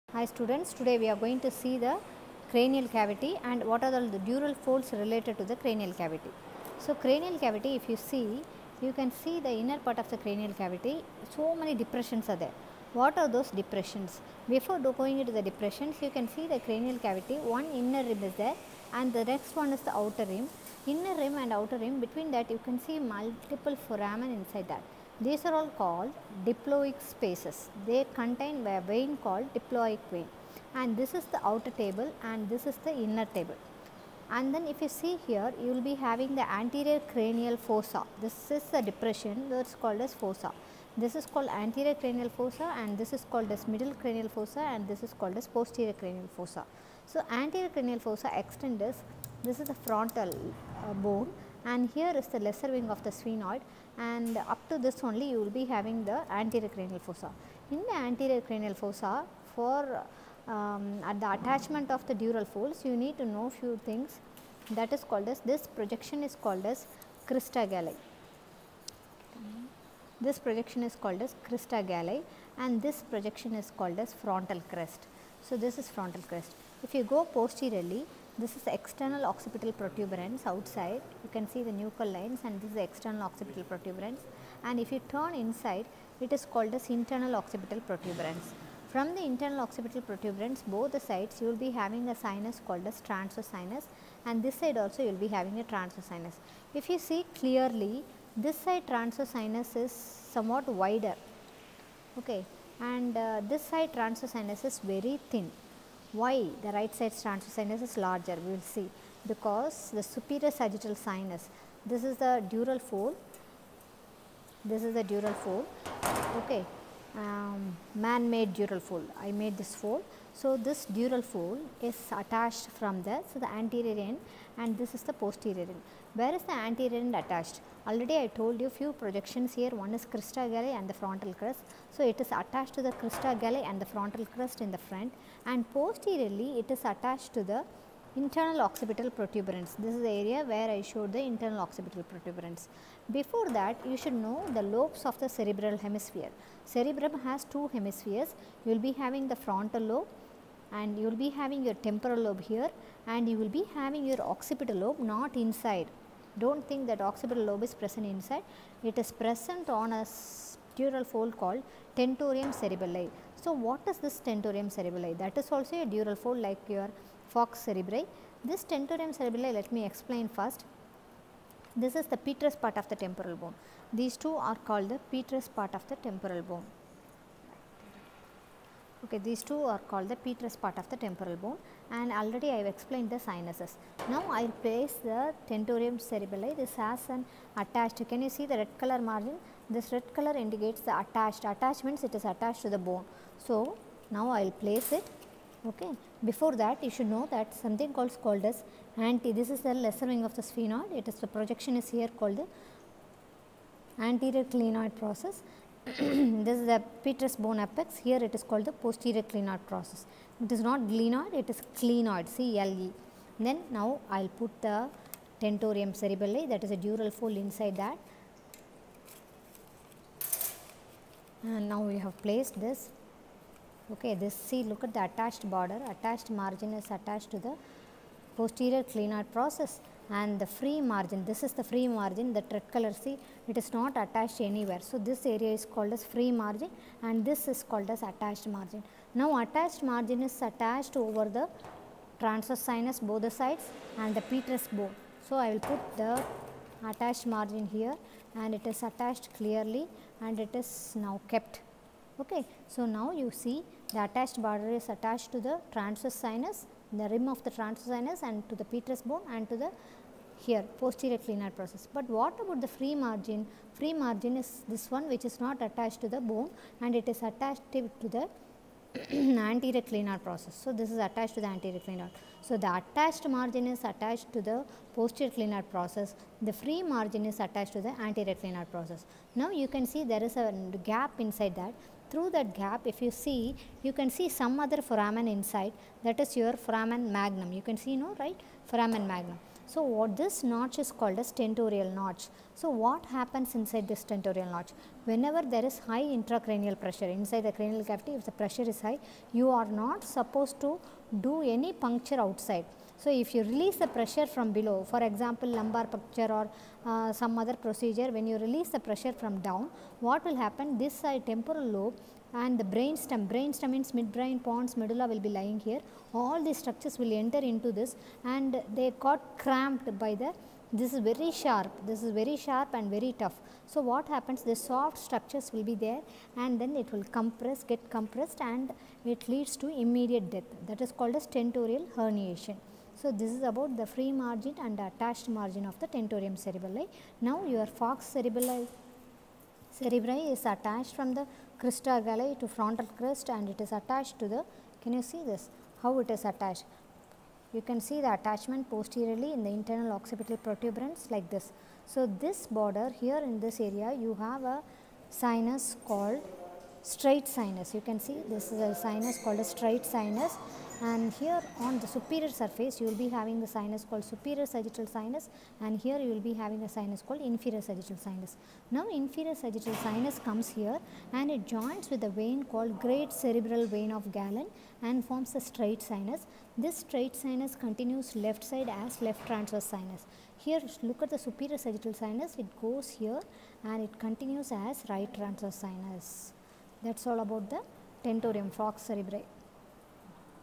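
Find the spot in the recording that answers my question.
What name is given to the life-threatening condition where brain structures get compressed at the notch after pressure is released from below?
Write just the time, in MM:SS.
05:31.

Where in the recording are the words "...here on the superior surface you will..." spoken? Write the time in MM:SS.
06:01.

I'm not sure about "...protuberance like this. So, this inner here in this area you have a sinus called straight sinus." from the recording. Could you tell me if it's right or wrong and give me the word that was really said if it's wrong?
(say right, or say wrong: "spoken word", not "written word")
wrong: "border", not "inner".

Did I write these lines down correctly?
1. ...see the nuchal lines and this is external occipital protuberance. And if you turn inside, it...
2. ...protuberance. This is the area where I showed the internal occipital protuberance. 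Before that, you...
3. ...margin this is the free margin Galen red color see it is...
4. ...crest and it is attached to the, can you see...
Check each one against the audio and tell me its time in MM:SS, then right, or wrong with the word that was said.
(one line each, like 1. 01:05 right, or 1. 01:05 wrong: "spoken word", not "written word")
1. 01:21 right
2. 02:19 right
3. 03:50 wrong: "The", not "Galen"
4. 05:42 right.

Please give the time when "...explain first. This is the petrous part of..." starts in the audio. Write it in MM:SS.
02:49.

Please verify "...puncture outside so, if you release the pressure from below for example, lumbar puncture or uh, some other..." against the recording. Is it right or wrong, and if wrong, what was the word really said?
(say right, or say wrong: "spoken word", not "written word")
right.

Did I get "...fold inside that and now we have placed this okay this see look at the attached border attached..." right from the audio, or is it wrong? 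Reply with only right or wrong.
right.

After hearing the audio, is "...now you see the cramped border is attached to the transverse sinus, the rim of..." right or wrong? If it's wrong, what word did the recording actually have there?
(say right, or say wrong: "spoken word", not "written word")
wrong: "attached", not "cramped".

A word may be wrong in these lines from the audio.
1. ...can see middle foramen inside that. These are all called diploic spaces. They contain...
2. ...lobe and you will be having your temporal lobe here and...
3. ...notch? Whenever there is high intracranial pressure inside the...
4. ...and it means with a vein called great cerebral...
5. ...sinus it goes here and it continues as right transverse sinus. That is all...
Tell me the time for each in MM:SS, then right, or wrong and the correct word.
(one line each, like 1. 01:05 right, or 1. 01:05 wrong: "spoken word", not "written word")
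1. 00:22 wrong: "multiple", not "middle"
2. 02:29 right
3. 04:54 right
4. 06:11 wrong: "joins", not "means"
5. 06:21 right.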